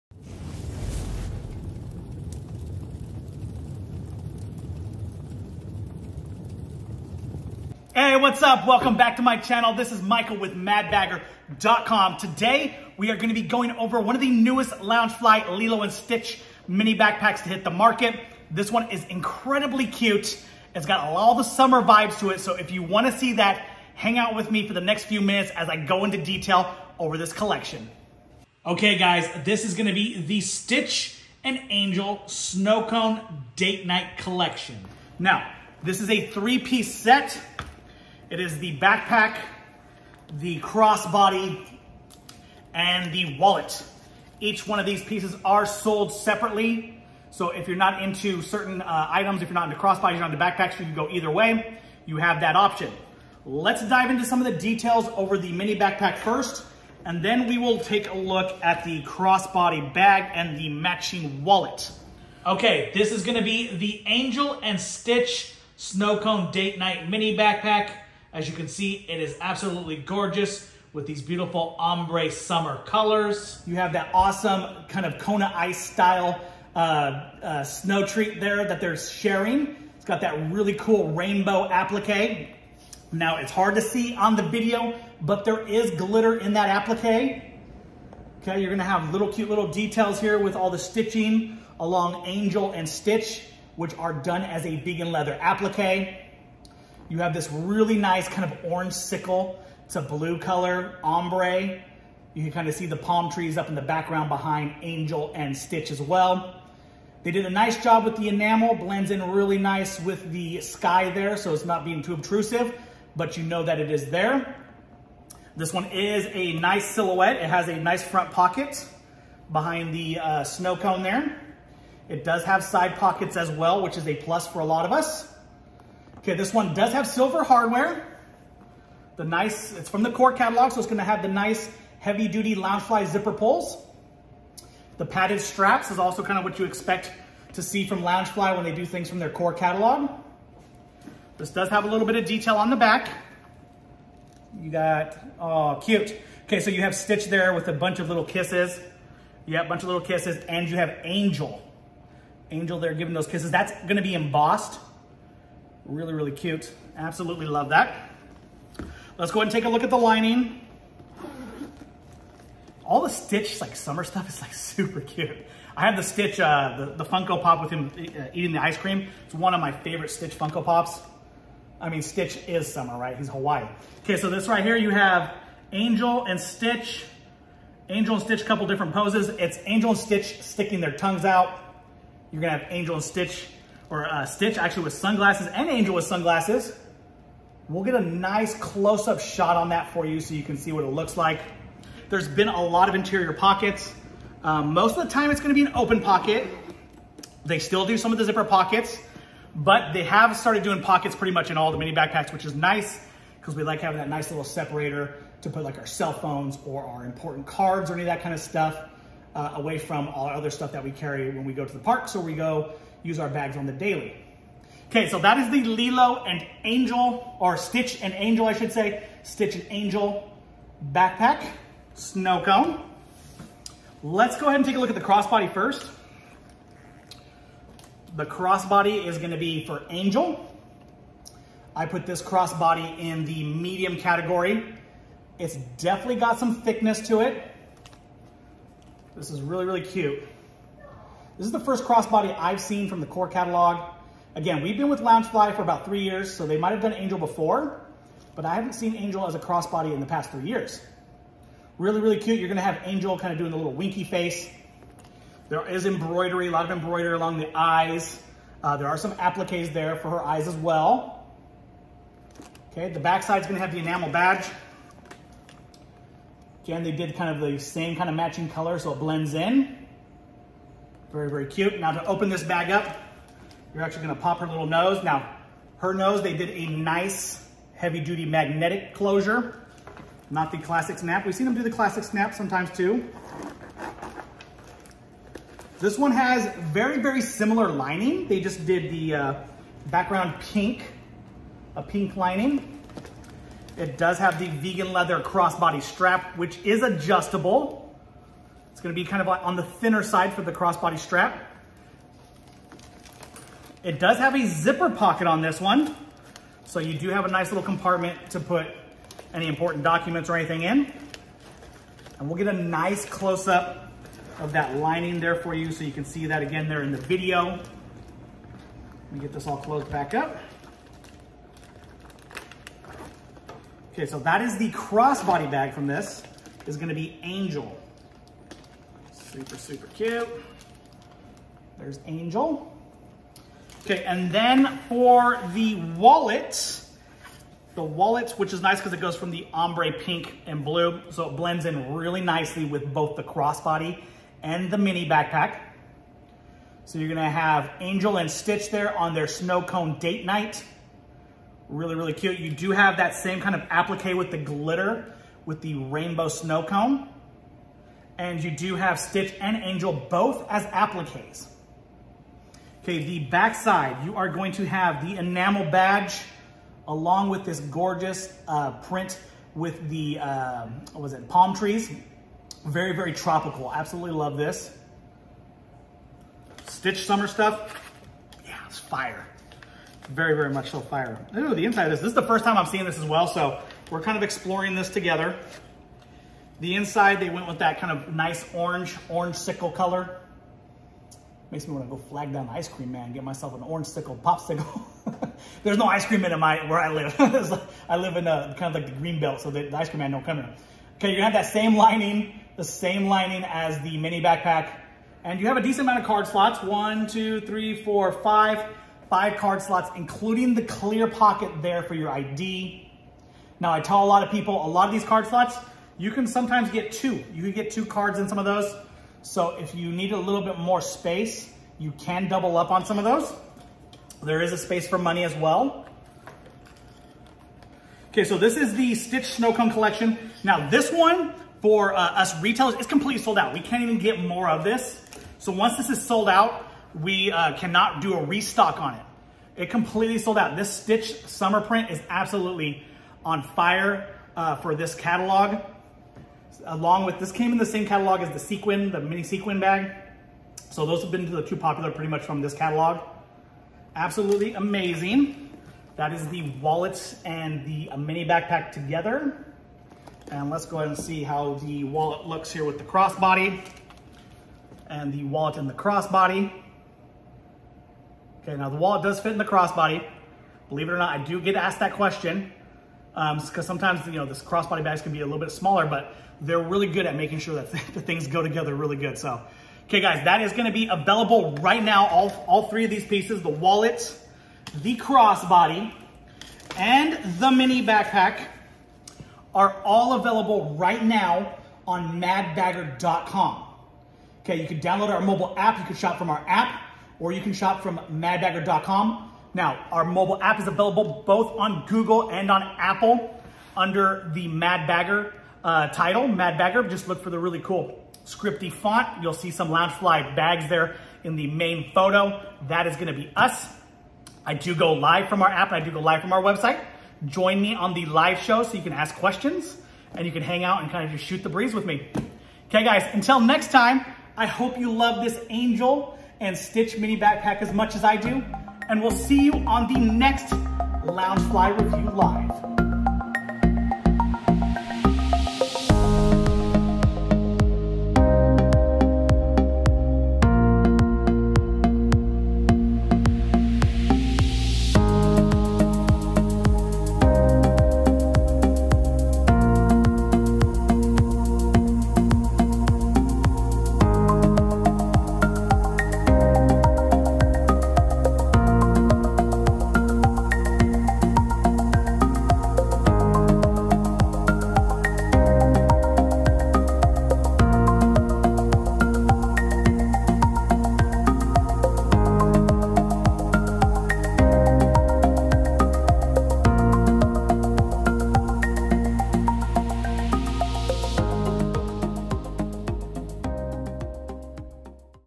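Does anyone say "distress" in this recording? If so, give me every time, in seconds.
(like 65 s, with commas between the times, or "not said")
not said.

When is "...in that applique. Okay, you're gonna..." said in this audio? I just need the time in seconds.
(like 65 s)
86 s.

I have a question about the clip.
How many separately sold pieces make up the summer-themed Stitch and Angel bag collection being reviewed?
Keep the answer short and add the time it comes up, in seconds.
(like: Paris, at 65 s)
3, at 36 s.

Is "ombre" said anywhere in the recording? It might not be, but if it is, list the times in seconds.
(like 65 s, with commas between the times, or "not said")
71 s, 101 s, 339 s.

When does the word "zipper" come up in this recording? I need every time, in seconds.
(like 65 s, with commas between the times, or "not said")
133 s, 198 s, 304 s.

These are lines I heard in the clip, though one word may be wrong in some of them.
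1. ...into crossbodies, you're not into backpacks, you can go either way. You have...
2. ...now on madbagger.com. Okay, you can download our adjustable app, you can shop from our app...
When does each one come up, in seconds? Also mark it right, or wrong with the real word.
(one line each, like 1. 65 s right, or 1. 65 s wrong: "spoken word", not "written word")
1. 49 s right
2. 491 s wrong: "mobile", not "adjustable".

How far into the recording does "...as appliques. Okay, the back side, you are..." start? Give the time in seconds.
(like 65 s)
360 s.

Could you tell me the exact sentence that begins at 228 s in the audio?
The crossbody is gonna be for Angel.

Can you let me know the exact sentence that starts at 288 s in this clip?
They just did the uh, background pink, a pink lining.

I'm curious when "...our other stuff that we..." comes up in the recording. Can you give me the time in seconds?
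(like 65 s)
210 s.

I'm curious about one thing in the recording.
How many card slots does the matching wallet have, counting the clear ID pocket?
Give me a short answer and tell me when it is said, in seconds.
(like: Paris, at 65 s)
5, at 409 s.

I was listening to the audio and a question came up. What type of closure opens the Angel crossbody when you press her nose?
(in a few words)
Magnetic closure.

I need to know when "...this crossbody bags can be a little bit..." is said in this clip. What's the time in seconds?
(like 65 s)
474 s.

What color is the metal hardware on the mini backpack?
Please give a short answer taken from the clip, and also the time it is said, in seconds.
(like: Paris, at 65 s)
Silver, at 127 s.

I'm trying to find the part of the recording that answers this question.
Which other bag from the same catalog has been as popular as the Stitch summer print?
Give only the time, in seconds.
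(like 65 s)
448 s.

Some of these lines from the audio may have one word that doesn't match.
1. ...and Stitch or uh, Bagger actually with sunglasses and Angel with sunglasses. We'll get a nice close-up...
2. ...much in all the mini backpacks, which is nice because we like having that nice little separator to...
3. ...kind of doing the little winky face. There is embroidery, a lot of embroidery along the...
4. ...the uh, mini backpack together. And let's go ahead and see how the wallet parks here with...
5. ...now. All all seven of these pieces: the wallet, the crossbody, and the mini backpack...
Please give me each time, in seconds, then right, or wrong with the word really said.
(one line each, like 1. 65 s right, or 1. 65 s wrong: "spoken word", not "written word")
1. 182 s wrong: "Stitch", not "Bagger"
2. 201 s right
3. 253 s right
4. 457 s wrong: "looks", not "parks"
5. 481 s wrong: "three", not "seven".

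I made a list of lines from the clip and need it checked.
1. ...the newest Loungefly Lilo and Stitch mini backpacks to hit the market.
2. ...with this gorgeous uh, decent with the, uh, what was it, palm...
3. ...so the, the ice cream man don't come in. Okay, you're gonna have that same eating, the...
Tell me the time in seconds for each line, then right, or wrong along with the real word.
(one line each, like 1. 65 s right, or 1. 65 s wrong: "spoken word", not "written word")
1. 14 s right
2. 367 s wrong: "print", not "decent"
3. 399 s wrong: "lining", not "eating".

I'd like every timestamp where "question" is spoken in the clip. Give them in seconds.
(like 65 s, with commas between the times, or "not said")
471 s, 519 s.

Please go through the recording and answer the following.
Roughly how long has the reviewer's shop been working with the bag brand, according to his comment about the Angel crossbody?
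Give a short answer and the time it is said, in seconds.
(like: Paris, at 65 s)
About 3 years, at 245 s.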